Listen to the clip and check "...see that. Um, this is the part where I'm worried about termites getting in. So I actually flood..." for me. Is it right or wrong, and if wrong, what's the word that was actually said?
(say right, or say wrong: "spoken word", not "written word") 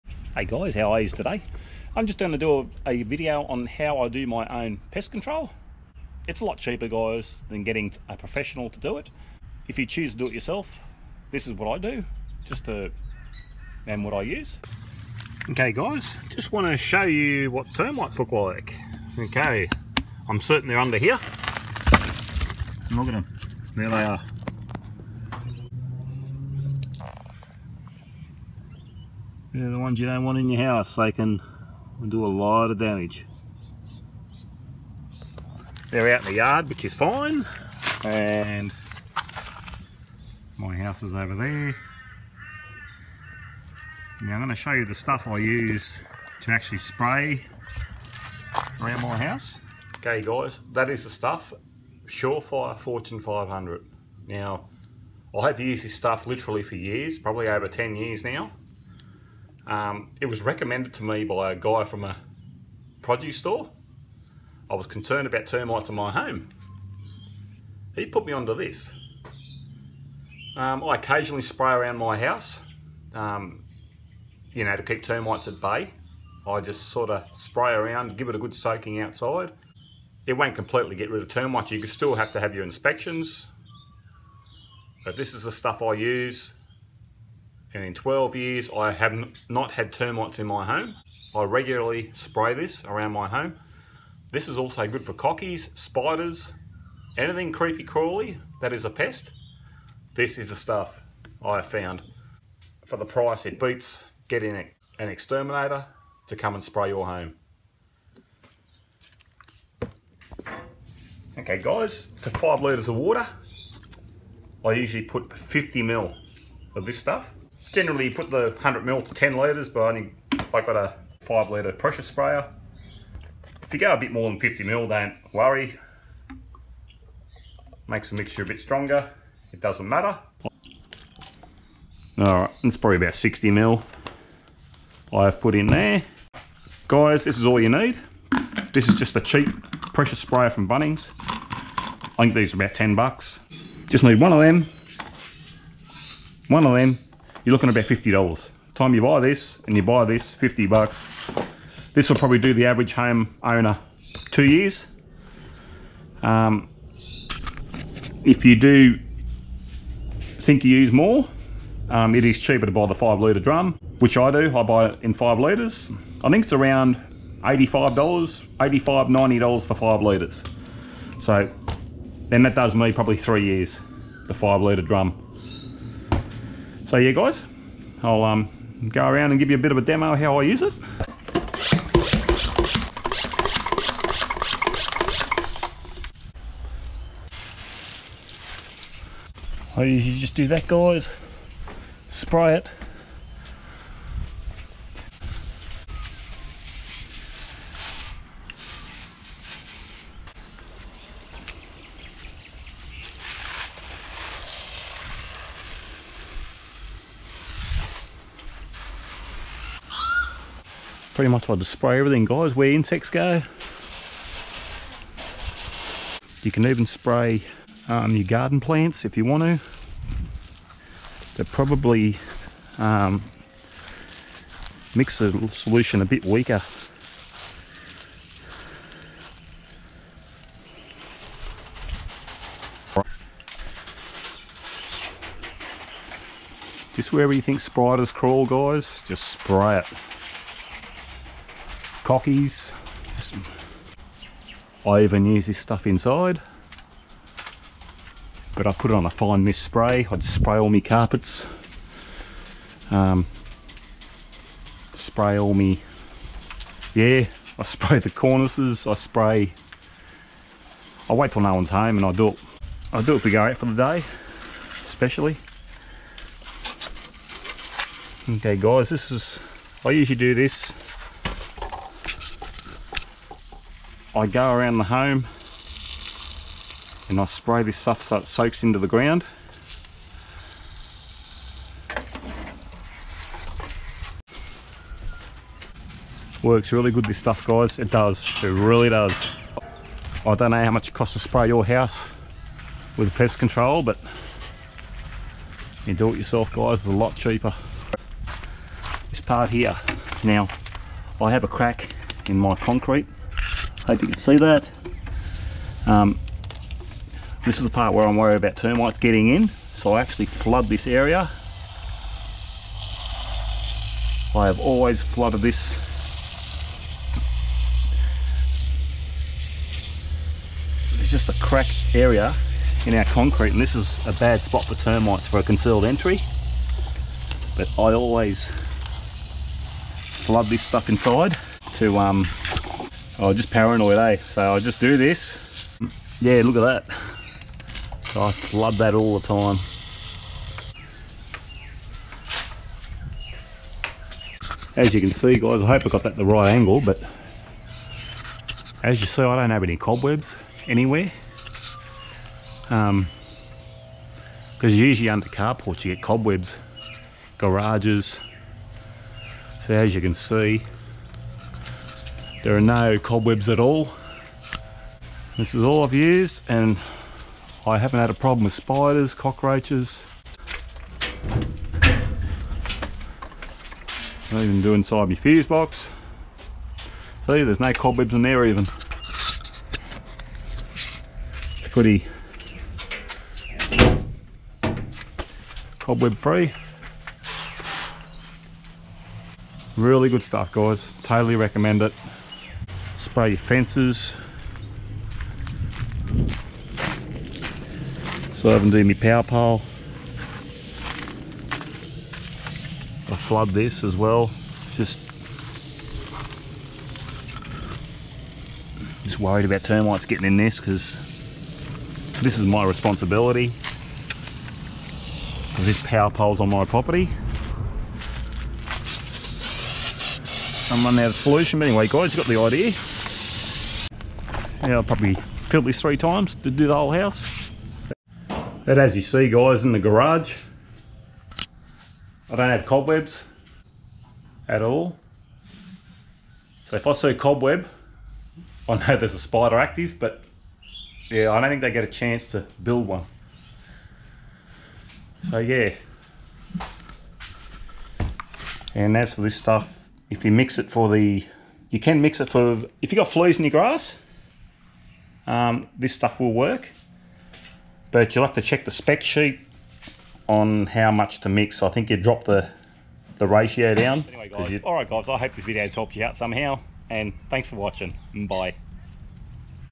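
right.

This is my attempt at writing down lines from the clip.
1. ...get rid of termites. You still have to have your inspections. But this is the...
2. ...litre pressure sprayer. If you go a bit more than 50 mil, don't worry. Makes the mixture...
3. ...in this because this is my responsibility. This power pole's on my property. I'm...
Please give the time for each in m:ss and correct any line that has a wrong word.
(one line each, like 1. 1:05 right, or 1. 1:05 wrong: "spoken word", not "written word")
1. 1:20 right
2. 2:01 right
3. 6:50 right.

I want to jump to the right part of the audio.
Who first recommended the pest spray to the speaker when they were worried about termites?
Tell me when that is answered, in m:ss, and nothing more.
1:01.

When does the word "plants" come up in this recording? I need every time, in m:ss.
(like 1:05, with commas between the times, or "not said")
3:38.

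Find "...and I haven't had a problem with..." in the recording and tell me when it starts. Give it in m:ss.
6:06.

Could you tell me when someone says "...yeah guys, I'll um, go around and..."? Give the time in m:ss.
2:56.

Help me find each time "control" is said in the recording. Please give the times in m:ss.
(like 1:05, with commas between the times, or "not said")
0:05, 4:53.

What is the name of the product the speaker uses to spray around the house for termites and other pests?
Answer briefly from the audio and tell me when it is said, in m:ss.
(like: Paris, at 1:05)
Surefire Fortune 500, at 0:52.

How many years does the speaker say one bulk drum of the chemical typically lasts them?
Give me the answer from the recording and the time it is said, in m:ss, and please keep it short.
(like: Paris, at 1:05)
3 years, at 2:53.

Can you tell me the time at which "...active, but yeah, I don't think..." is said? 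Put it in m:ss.
7:19.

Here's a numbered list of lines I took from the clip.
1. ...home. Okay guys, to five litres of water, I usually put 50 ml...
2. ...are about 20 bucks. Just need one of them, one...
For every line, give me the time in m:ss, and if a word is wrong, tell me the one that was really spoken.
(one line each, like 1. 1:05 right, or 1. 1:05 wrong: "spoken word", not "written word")
1. 1:47 right
2. 2:22 wrong: "10", not "20".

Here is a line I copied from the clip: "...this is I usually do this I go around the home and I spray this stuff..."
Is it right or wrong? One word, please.
right.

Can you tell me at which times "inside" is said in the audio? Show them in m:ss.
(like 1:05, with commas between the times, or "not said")
4:05, 5:30, 6:14.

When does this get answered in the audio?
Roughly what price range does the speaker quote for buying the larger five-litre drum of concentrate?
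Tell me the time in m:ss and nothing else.
2:48.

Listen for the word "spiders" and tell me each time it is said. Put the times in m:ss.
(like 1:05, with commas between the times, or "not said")
1:35, 3:57, 6:08, 7:19.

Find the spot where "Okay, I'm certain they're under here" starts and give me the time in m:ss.
0:19.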